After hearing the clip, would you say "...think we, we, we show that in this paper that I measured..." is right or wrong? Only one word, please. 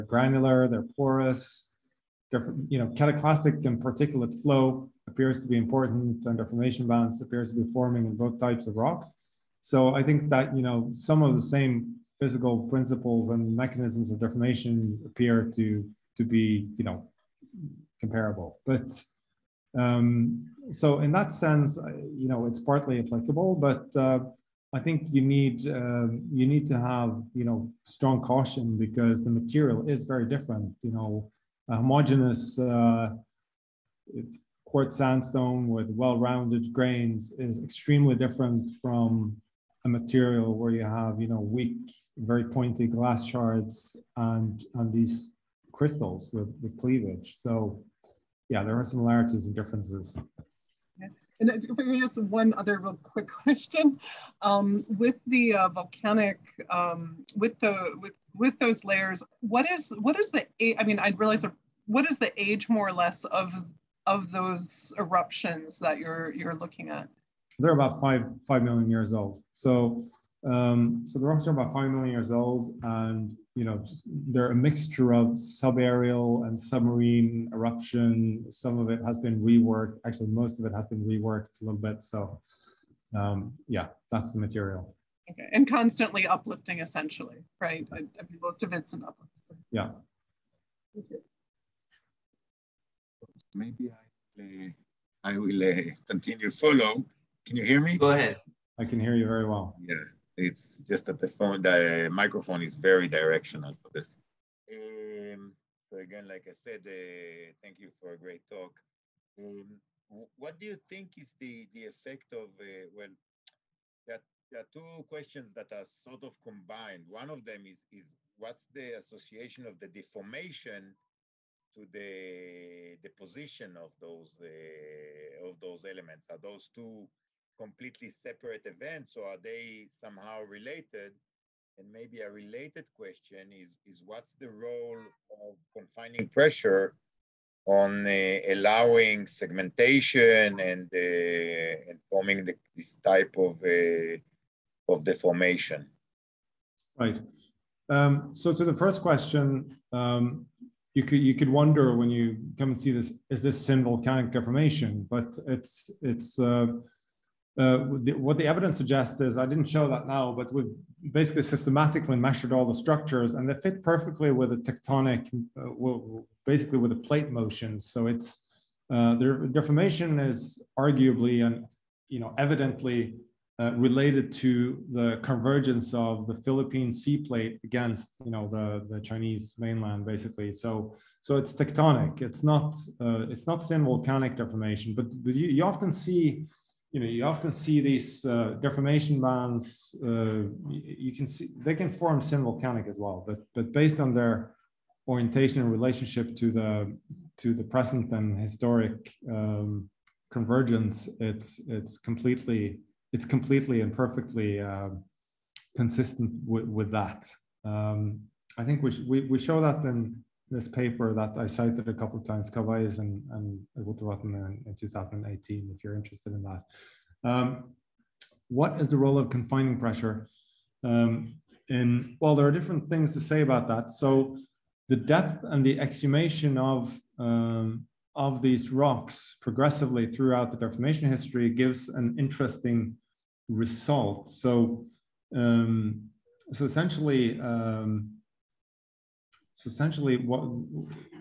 wrong.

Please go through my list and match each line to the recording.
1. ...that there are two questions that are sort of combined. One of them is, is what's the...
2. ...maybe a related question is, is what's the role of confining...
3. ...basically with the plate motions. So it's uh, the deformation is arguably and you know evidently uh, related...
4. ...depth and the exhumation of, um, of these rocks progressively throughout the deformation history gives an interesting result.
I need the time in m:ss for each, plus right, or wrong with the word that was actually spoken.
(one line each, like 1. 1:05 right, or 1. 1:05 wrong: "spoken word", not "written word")
1. 1:54 right
2. 2:11 right
3. 2:46 right
4. 3:44 right.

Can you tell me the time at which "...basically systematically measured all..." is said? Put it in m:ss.
2:41.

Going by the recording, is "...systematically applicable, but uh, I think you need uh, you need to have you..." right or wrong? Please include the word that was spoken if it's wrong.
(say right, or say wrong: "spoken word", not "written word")
wrong: "partly", not "systematically".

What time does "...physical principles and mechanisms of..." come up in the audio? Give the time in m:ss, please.
0:12.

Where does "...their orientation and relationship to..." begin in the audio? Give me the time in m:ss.
3:14.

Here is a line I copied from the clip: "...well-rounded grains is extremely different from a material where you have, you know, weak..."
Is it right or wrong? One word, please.
right.